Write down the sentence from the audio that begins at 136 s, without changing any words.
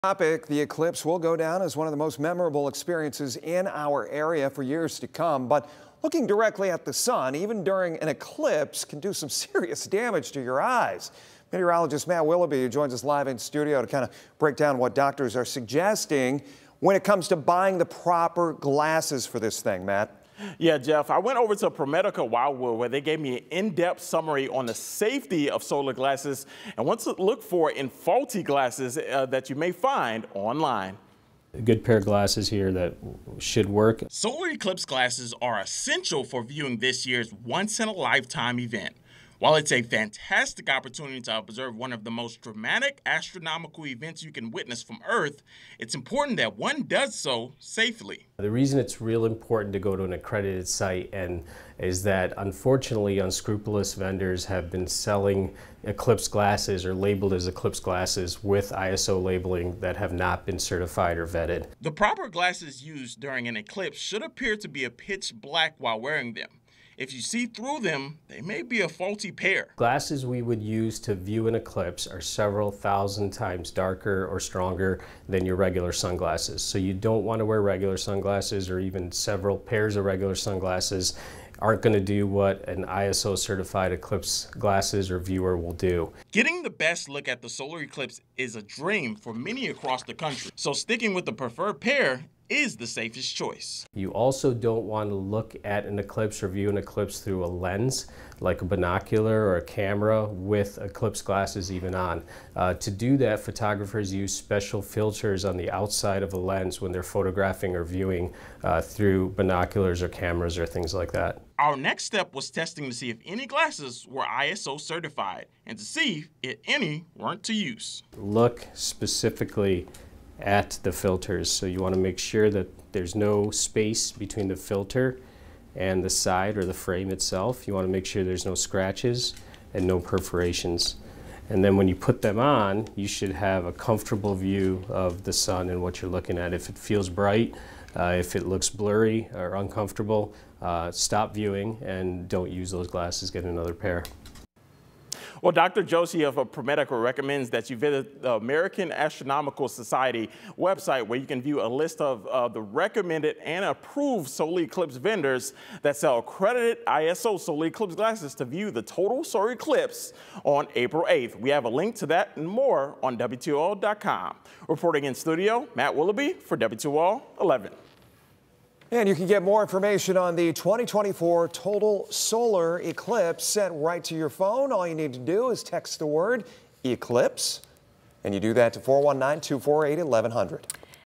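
If it feels bright, uh, if it looks blurry or uncomfortable, uh, stop viewing and don't use those glasses, get another pair.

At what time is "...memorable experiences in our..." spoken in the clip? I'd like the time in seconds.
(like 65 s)
2 s.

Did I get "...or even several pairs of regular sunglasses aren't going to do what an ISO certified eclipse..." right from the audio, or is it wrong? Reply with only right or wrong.
right.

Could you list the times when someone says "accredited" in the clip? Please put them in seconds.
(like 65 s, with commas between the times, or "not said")
50 s, 156 s.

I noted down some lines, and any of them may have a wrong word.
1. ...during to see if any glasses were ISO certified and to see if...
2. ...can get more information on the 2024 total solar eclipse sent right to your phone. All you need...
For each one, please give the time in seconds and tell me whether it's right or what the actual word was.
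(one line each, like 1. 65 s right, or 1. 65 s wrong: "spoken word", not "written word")
1. 112 s wrong: "testing", not "during"
2. 169 s right.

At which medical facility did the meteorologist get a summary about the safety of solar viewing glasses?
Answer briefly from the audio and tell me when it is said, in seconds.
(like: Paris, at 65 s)
ProMedica Wildwood, at 21 s.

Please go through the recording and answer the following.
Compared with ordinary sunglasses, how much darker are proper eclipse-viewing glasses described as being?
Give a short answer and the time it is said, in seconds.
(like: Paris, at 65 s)
several thousand times, at 72 s.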